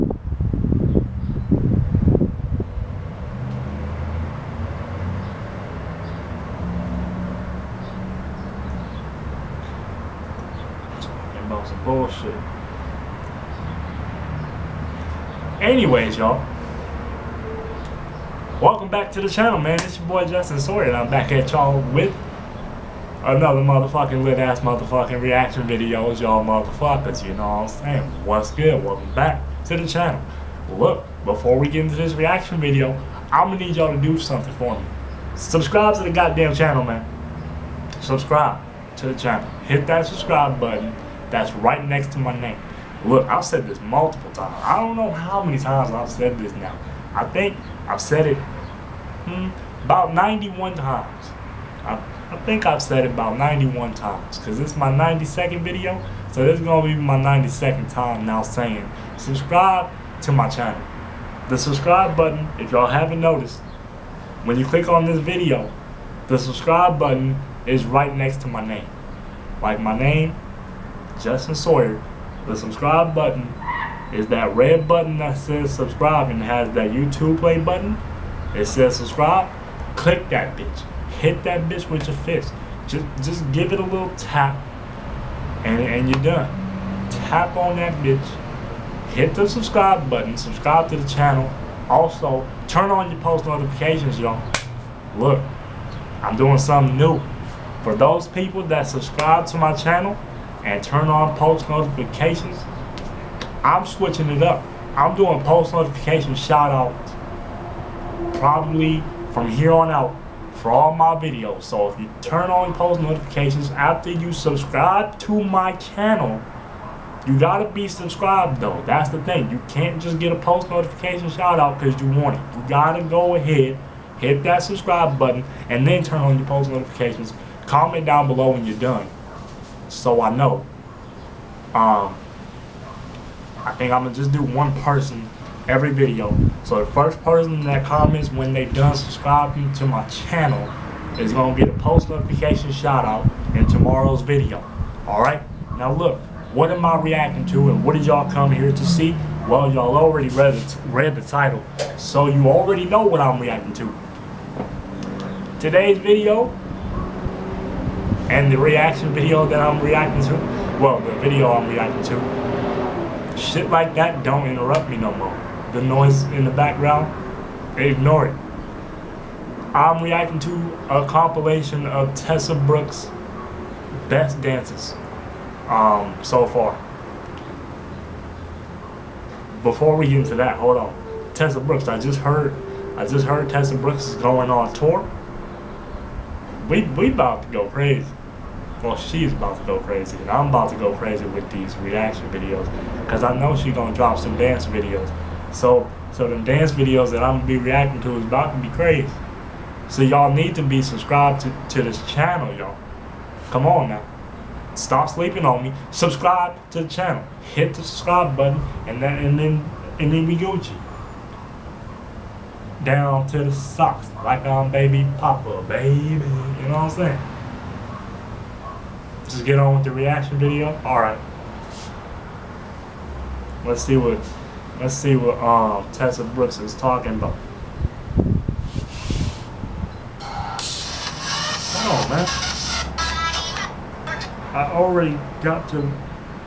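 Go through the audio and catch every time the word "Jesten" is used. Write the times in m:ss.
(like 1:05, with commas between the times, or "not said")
0:20, 1:11.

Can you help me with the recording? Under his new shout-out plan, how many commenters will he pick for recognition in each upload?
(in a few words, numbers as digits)
1.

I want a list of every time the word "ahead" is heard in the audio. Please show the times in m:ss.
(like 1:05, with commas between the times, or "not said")
2:03.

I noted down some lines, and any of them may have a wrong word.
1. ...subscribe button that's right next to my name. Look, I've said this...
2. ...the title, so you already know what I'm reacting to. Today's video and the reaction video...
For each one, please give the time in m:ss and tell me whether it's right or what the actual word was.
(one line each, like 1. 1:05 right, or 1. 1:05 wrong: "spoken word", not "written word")
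1. 0:40 right
2. 2:31 right.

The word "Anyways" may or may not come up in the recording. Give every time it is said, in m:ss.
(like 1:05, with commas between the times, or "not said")
0:15.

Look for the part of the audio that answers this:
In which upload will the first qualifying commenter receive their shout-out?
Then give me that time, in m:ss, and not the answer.
2:23.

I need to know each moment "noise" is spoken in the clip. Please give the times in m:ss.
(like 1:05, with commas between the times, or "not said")
2:45.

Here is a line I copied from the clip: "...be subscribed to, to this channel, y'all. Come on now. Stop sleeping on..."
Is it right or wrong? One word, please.
right.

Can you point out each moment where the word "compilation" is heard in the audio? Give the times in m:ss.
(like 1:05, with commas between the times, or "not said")
2:51.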